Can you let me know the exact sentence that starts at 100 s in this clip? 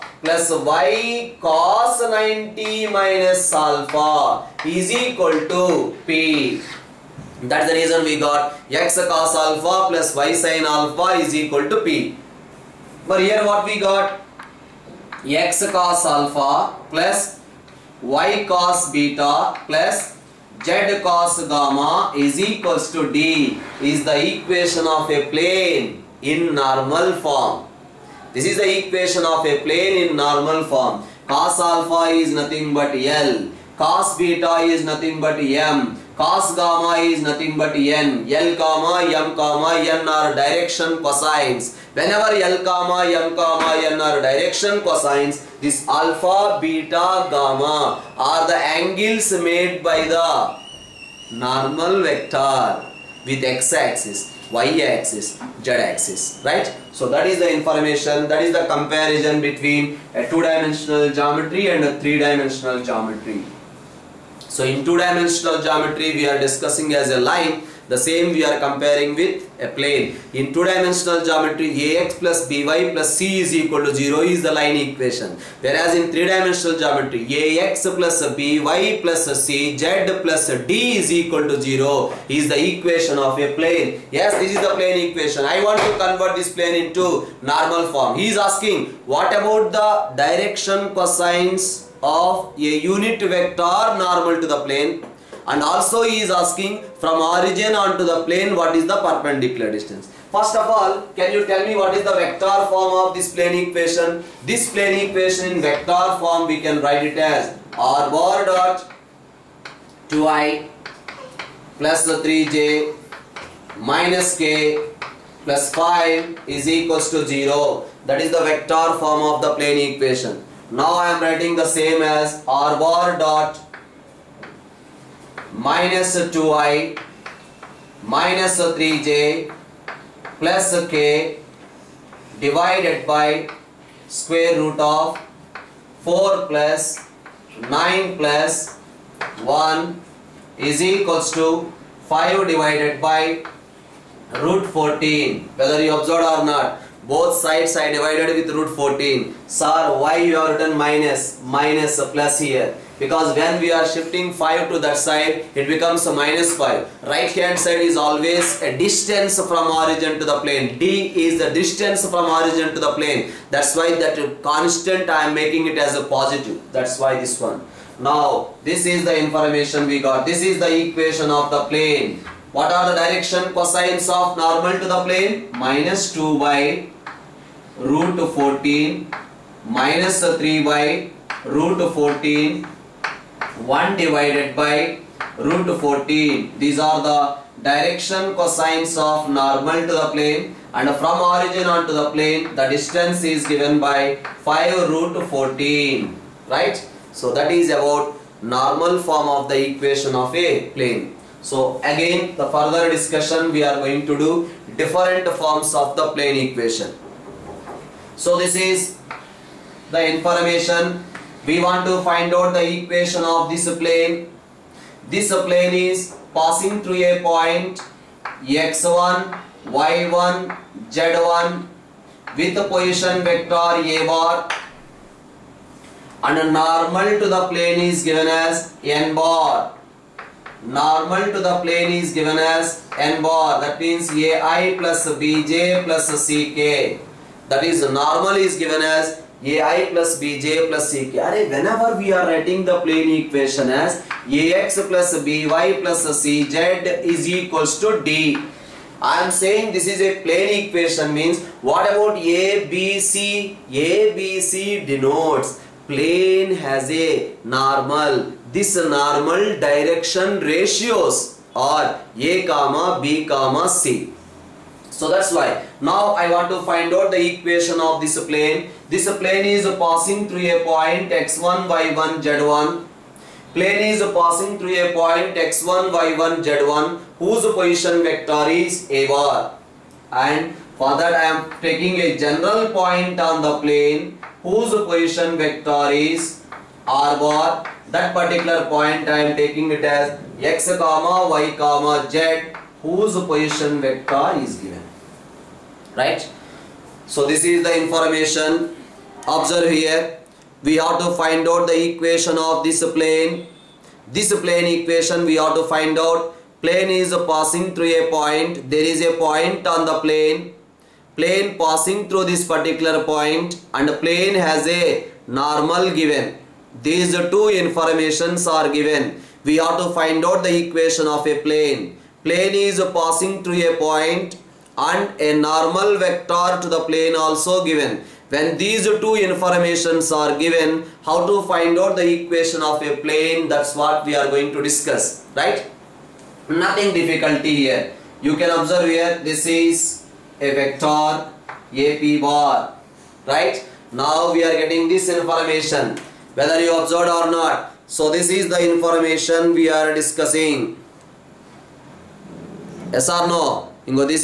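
First of all, can you tell me what is the vector form of this plane equation?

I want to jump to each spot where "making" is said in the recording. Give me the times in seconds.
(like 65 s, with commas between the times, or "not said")
165 s.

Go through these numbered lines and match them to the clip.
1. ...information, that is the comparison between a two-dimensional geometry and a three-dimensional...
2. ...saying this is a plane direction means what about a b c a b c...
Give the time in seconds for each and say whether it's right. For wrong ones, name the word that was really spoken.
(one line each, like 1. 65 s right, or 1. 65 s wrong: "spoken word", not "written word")
1. 57 s right
2. 249 s wrong: "equation", not "direction".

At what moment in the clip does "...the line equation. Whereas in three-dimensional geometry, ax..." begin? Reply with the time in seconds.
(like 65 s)
74 s.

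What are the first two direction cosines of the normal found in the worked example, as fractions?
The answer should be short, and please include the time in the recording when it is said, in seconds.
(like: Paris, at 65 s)
-2/√14 and -3/√14, at 175 s.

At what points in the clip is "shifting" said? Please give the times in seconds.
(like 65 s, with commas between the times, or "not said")
153 s.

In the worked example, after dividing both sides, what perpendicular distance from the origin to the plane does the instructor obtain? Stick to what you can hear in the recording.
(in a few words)
5/√14.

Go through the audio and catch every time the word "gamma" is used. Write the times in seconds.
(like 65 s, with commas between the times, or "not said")
21 s, 36 s, 47 s.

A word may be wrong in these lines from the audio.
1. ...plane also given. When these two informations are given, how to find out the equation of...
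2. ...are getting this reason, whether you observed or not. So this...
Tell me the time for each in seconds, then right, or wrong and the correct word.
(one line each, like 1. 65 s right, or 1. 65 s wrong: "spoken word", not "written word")
1. 326 s right
2. 344 s wrong: "information", not "reason".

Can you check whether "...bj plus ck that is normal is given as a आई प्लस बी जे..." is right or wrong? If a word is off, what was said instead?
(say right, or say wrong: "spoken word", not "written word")
right.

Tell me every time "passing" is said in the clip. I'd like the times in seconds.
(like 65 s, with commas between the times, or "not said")
216 s, 269 s, 274 s, 307 s, 311 s, 322 s.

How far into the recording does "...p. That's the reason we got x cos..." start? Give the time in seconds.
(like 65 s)
6 s.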